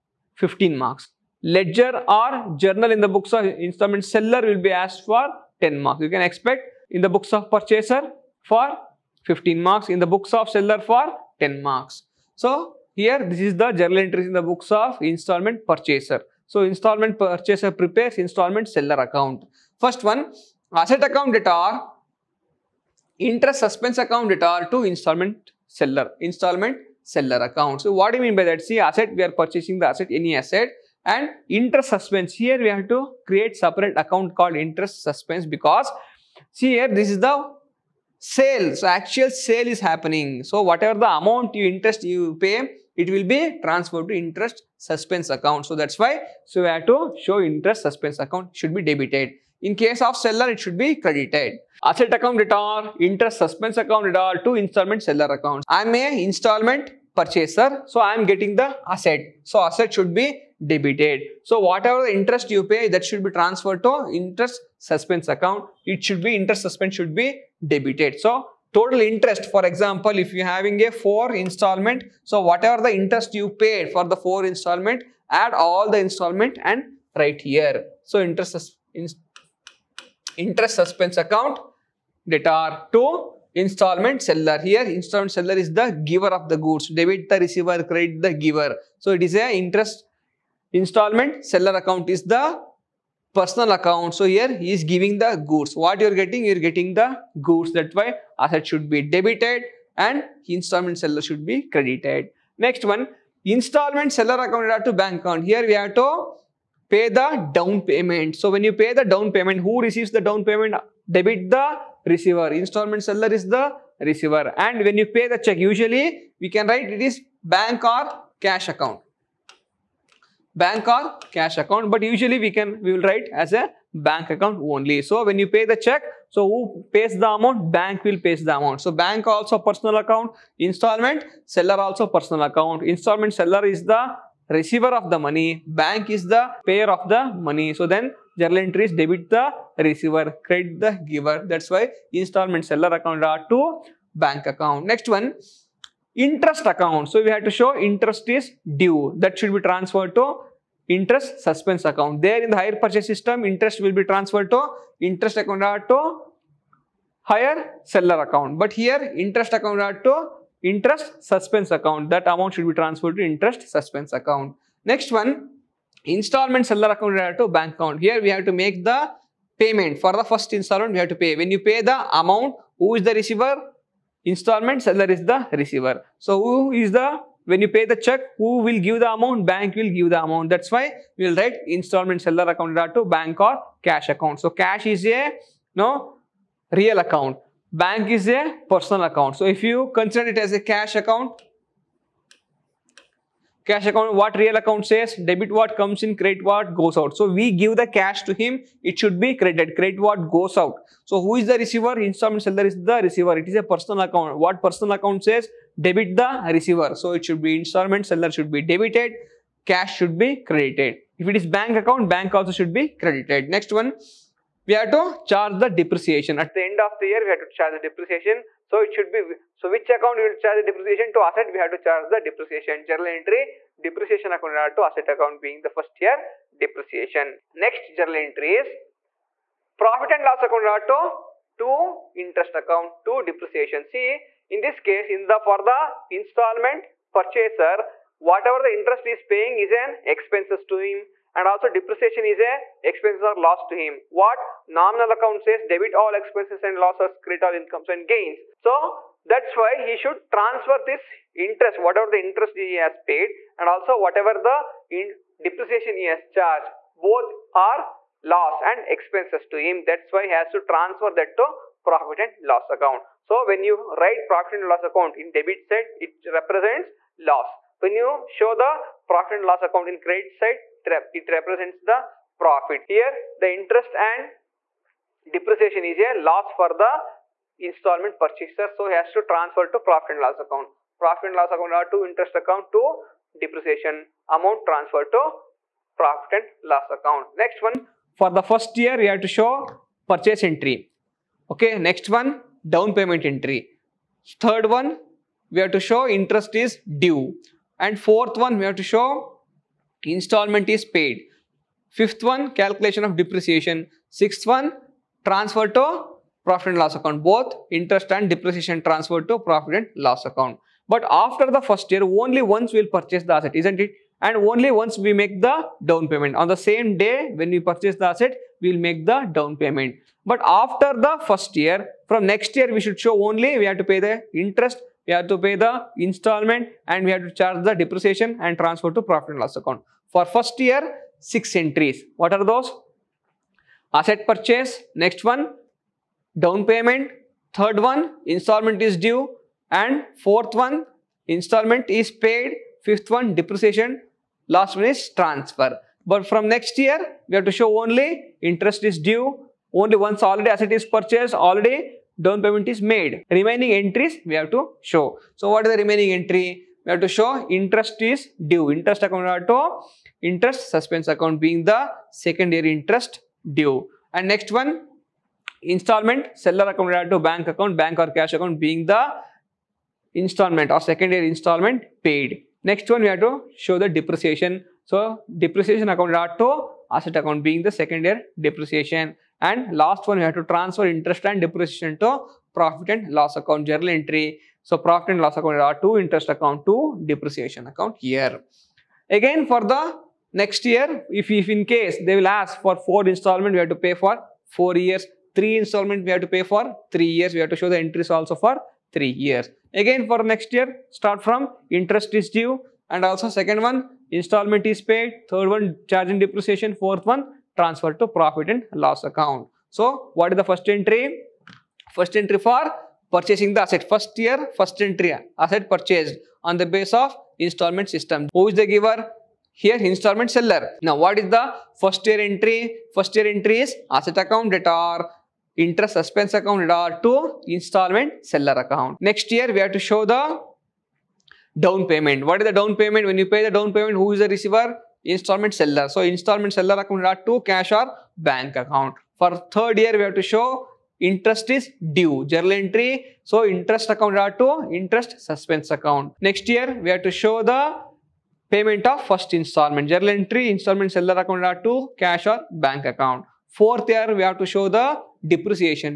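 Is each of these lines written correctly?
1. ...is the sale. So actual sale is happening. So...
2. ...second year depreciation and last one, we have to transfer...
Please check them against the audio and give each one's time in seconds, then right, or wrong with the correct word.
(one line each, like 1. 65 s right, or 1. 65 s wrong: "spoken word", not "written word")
1. 37 s right
2. 377 s right.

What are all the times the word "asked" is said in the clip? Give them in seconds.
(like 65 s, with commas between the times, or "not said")
4 s.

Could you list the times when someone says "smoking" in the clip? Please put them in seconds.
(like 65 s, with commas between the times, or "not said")
not said.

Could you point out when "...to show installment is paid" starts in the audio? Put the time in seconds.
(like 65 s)
298 s.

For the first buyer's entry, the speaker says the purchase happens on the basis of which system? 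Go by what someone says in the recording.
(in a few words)
installment system.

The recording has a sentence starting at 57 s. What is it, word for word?
So I am getting the asset.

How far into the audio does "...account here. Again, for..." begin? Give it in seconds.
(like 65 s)
387 s.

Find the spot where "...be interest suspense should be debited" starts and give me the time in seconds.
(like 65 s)
66 s.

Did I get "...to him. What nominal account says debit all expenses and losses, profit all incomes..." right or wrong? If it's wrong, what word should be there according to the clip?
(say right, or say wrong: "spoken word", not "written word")
wrong: "credit", not "profit".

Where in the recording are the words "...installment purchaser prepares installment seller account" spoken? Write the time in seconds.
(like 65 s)
16 s.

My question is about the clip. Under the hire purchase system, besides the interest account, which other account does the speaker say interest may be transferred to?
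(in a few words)
hire seller account.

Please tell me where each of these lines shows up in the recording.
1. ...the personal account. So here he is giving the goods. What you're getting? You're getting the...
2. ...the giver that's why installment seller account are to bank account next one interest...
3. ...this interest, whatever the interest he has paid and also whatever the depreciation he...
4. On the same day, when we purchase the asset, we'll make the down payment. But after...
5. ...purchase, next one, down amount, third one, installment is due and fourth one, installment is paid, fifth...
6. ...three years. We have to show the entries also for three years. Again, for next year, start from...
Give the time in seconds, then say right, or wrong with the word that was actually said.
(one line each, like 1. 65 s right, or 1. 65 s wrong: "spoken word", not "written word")
1. 92 s right
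2. 140 s right
3. 250 s right
4. 316 s right
5. 334 s wrong: "payment", not "amount"
6. 396 s right.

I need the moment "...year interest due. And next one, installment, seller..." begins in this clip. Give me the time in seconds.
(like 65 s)
362 s.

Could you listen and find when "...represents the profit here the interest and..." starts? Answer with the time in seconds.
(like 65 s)
271 s.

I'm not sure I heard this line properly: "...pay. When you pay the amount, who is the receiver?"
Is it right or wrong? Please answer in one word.
right.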